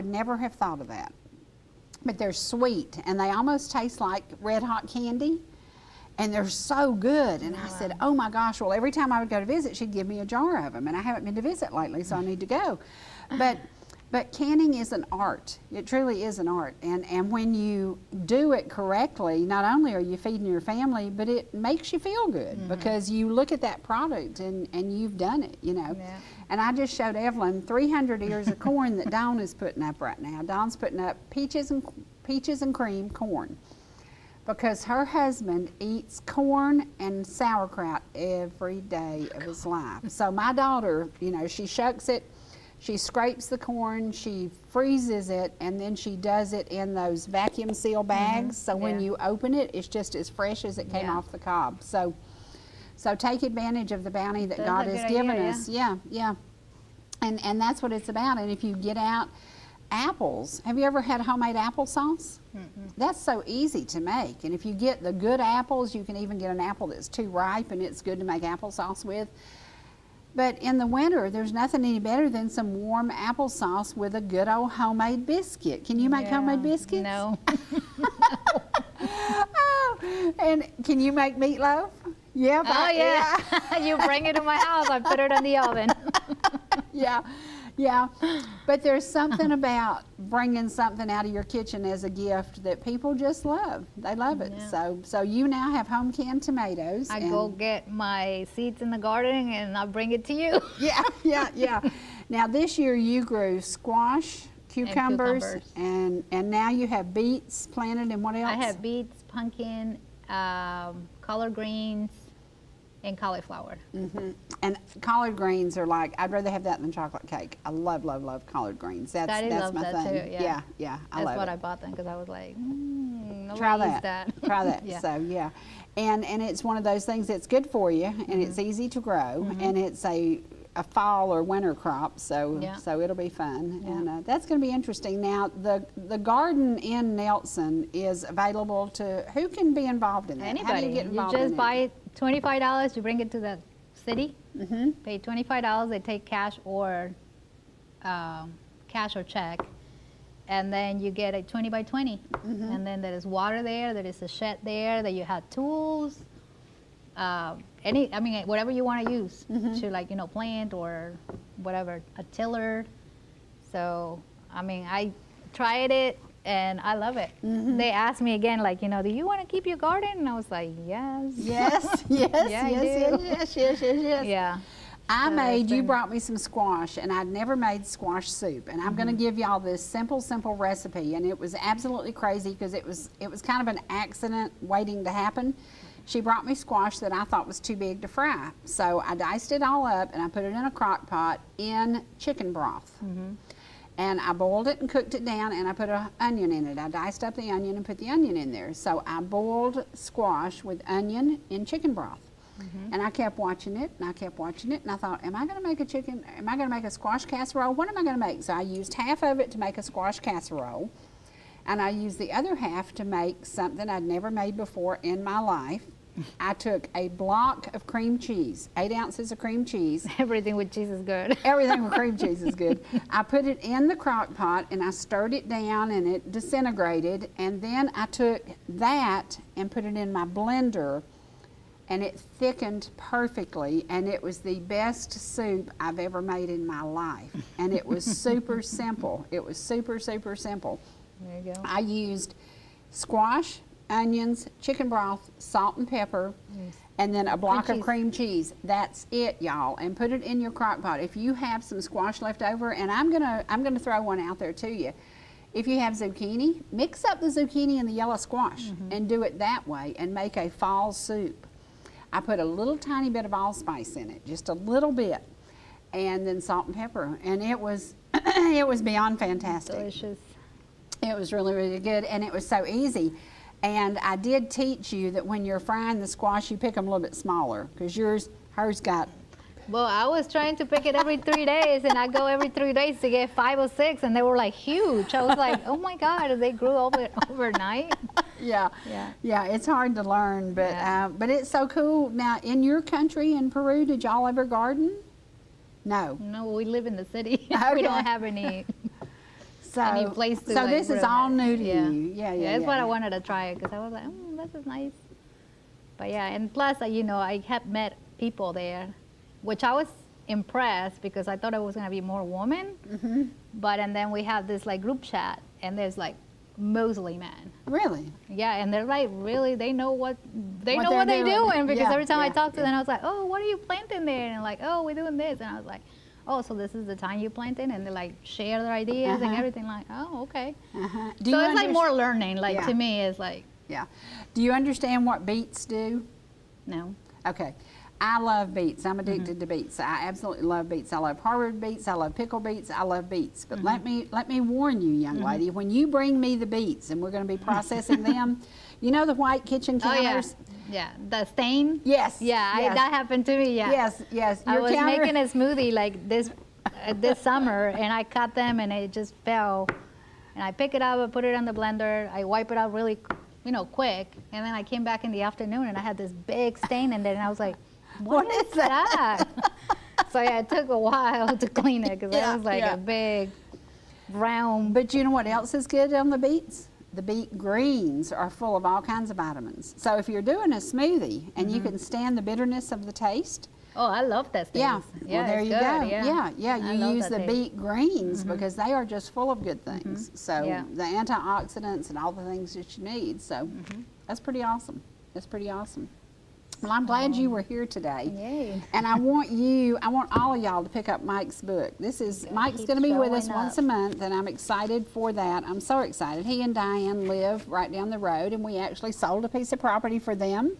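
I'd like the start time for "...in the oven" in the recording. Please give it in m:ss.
1:25.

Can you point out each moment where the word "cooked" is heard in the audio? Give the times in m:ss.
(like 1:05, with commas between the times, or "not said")
3:14.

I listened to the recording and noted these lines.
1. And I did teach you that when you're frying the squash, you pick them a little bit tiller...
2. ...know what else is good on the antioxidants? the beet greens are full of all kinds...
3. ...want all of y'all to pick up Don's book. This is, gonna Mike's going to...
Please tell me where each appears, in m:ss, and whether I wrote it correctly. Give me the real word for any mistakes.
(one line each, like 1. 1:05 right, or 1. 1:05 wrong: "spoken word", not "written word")
1. 4:33 wrong: "smaller", not "tiller"
2. 6:15 wrong: "beets", not "antioxidants"
3. 6:39 wrong: "Mike", not "Don".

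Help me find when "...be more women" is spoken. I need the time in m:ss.
5:11.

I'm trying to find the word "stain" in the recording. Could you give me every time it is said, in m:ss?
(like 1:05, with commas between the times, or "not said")
5:51, 6:06.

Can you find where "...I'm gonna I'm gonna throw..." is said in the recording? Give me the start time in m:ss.
4:12.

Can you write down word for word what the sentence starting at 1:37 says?
I go get my seeds in the garden and I bring it to you.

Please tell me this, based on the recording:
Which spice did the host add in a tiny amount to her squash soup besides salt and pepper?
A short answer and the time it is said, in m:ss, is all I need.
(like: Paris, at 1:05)
allspice, at 4:23.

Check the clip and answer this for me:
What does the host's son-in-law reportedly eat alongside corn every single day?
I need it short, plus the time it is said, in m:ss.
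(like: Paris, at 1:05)
sauerkraut, at 0:37.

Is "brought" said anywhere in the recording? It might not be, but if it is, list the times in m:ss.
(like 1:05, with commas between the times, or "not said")
2:55, 3:06.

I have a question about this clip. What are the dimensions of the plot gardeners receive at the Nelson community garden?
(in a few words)
20 by 20.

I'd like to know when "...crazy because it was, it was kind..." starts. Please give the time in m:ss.
3:02.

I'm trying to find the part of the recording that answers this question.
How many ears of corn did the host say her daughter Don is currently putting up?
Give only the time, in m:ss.
0:27.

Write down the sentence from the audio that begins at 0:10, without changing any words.
And I haven't been to visit lately, so I need to go.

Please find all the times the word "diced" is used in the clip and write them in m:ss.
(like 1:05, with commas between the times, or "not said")
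3:09, 3:16.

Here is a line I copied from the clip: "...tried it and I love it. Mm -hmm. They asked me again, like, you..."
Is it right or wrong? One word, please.
right.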